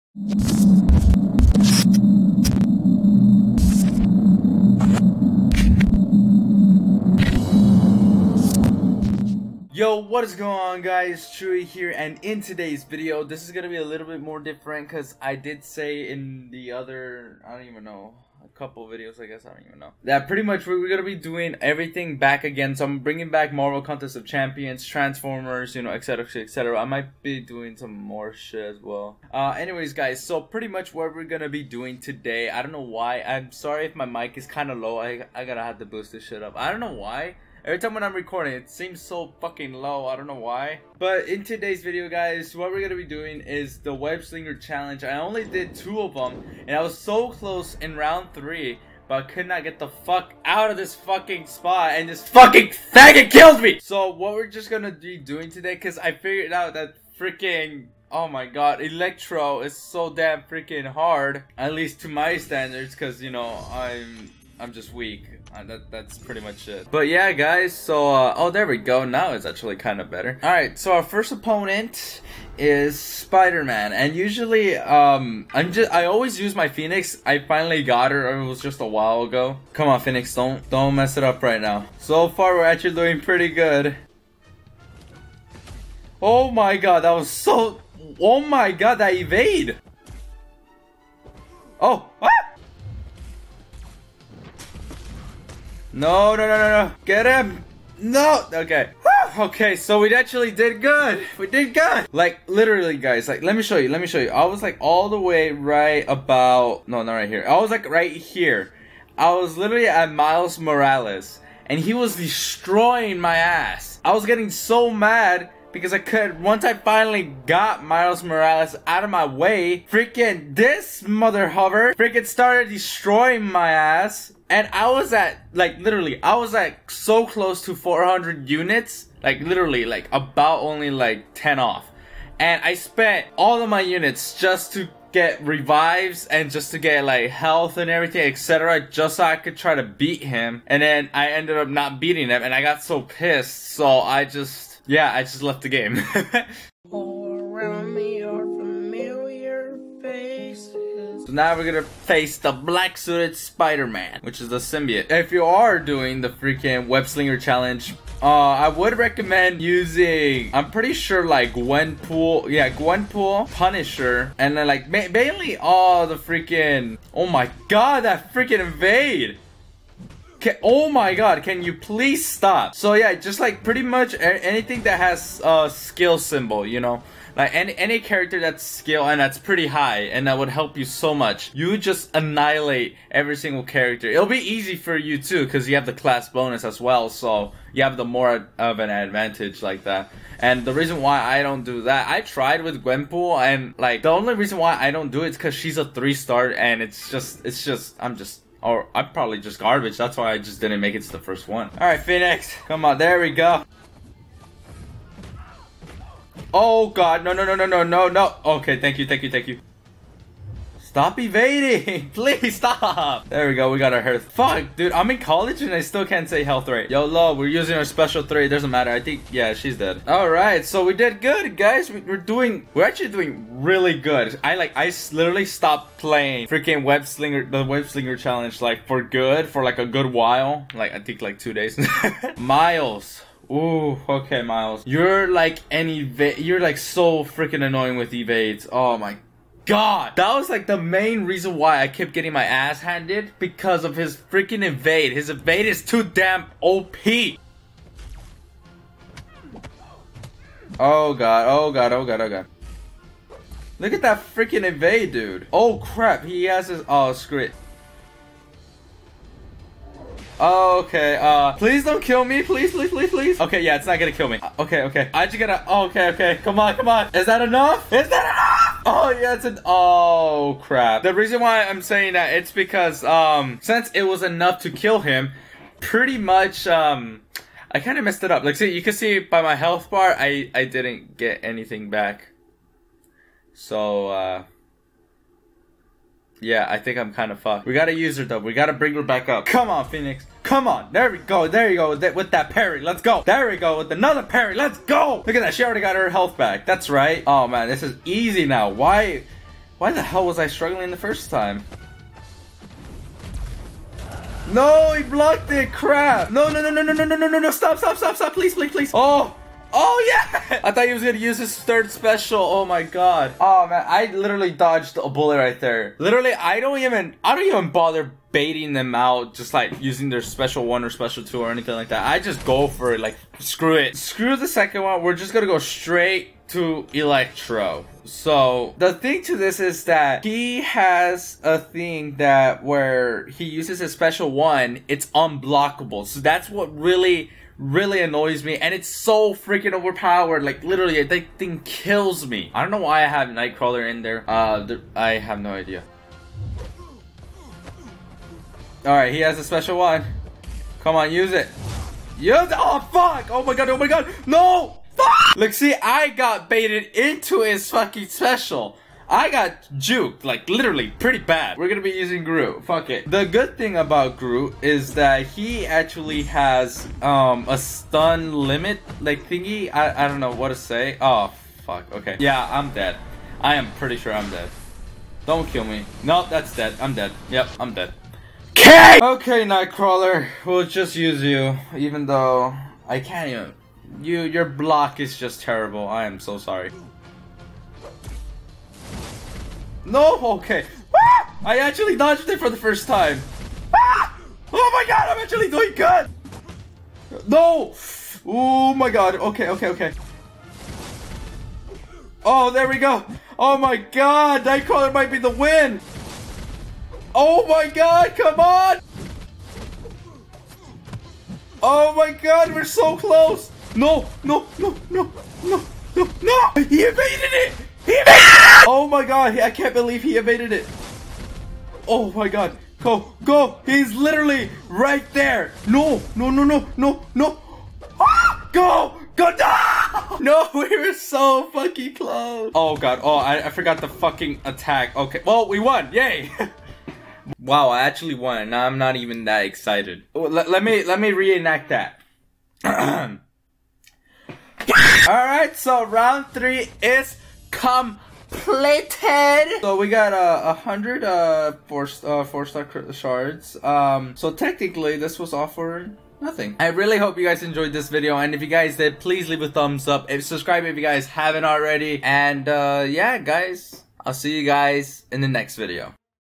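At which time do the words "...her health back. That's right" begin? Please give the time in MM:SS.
04:55.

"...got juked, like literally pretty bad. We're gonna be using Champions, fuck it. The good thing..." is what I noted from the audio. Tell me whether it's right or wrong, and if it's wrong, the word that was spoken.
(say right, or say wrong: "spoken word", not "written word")
wrong: "Groot", not "Champions".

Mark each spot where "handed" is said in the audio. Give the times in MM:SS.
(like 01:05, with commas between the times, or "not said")
04:02.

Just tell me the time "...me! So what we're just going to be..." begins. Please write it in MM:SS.
00:53.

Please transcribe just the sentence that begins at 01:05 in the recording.
Uh, that, that's pretty much it.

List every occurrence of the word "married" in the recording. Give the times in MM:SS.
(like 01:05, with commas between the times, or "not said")
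not said.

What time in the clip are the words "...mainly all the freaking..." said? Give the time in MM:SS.
02:45.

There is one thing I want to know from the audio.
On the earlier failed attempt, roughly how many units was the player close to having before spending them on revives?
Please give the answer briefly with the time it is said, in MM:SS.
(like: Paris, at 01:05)
400, at 02:07.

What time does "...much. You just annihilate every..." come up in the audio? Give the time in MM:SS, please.
03:01.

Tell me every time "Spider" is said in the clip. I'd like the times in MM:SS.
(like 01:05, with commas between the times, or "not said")
01:12, 02:33.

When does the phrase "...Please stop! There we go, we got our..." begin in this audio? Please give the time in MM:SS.
03:32.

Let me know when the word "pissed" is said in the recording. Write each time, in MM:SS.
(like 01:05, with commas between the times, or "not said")
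02:23.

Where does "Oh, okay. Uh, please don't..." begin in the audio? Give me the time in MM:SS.
04:20.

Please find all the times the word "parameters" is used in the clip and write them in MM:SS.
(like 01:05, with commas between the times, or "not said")
not said.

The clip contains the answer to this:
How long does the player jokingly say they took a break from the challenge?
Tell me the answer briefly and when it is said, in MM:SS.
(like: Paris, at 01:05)
Two days, at 03:51.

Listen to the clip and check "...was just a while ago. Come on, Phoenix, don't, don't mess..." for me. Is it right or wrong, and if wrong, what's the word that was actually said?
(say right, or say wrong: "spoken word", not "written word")
right.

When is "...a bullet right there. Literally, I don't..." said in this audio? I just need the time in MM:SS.
05:14.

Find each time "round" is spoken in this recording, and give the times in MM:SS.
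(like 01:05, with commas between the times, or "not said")
00:47, 07:25.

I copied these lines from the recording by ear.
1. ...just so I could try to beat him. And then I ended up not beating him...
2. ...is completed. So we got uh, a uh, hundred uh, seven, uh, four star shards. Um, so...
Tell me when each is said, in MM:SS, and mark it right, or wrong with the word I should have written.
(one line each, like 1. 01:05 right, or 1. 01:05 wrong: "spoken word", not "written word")
1. 02:18 right
2. 07:26 wrong: "four", not "seven".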